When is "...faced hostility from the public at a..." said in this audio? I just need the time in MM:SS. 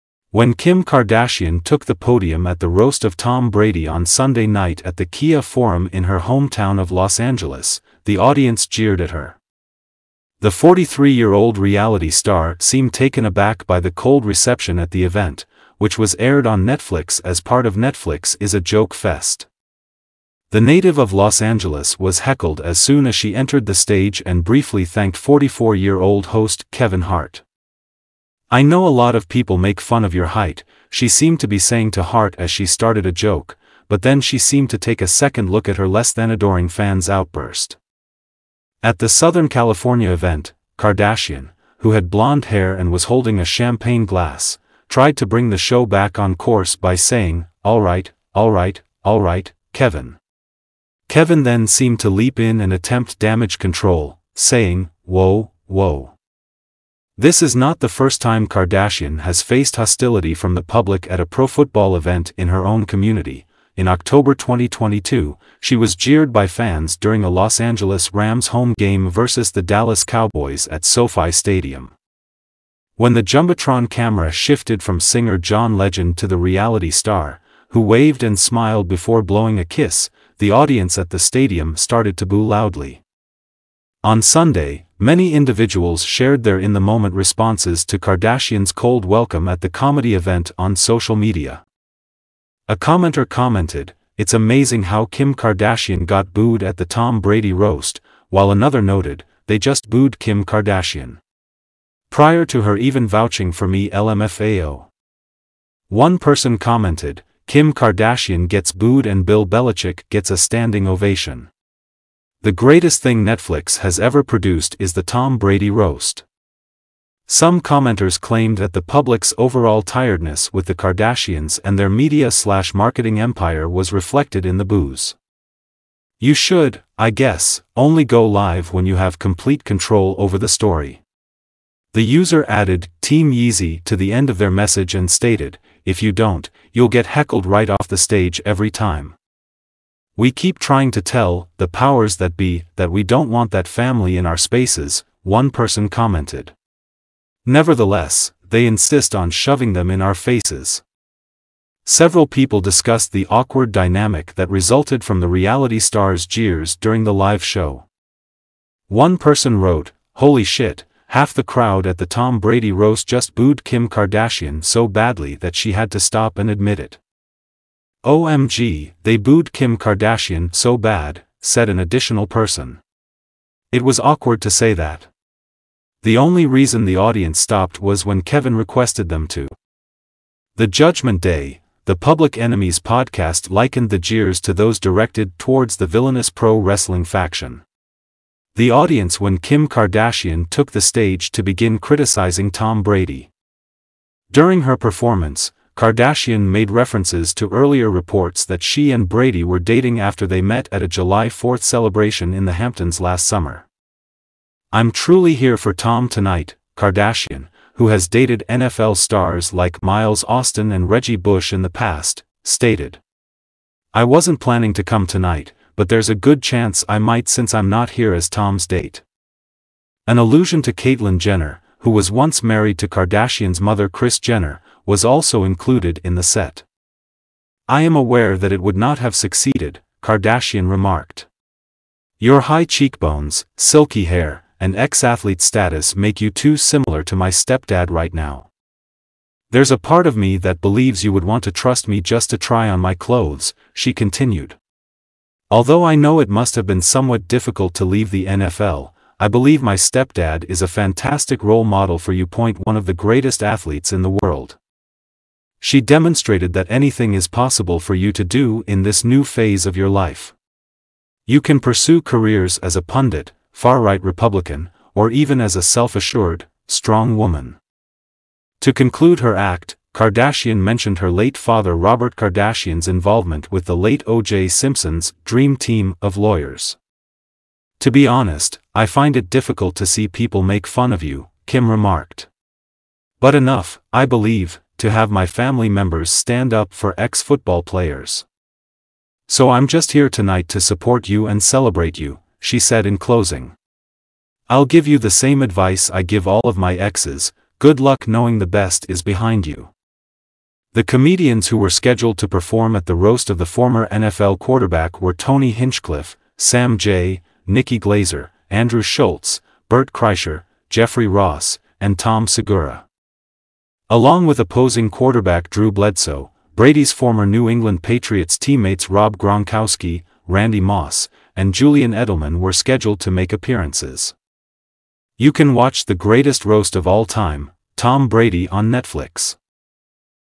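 00:59.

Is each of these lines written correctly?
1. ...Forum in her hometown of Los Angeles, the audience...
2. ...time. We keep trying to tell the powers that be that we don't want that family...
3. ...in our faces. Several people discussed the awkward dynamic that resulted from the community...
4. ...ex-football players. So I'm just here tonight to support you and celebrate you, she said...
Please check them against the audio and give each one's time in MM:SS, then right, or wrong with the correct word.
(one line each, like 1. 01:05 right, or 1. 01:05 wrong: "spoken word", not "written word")
1. 00:05 right
2. 02:18 right
3. 02:29 wrong: "reality", not "community"
4. 04:46 right.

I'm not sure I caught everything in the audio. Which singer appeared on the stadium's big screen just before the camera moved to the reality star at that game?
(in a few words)
John Legend.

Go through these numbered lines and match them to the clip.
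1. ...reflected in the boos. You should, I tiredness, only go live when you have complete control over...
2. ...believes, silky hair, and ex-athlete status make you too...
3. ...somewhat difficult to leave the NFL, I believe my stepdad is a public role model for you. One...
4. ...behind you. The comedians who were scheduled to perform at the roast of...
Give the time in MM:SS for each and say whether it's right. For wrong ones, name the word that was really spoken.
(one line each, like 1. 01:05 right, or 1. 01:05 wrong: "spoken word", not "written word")
1. 02:03 wrong: "guess", not "tiredness"
2. 03:52 wrong: "cheekbones", not "believes"
3. 04:06 wrong: "fantastic", not "public"
4. 04:59 right.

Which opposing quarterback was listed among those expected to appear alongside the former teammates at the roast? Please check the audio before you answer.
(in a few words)
Drew Bledsoe.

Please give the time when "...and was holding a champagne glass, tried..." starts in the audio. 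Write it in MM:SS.
00:42.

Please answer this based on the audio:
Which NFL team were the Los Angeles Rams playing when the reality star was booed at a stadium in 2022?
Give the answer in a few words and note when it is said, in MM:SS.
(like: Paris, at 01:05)
Dallas Cowboys, at 01:09.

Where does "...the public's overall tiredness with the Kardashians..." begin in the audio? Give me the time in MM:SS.
01:58.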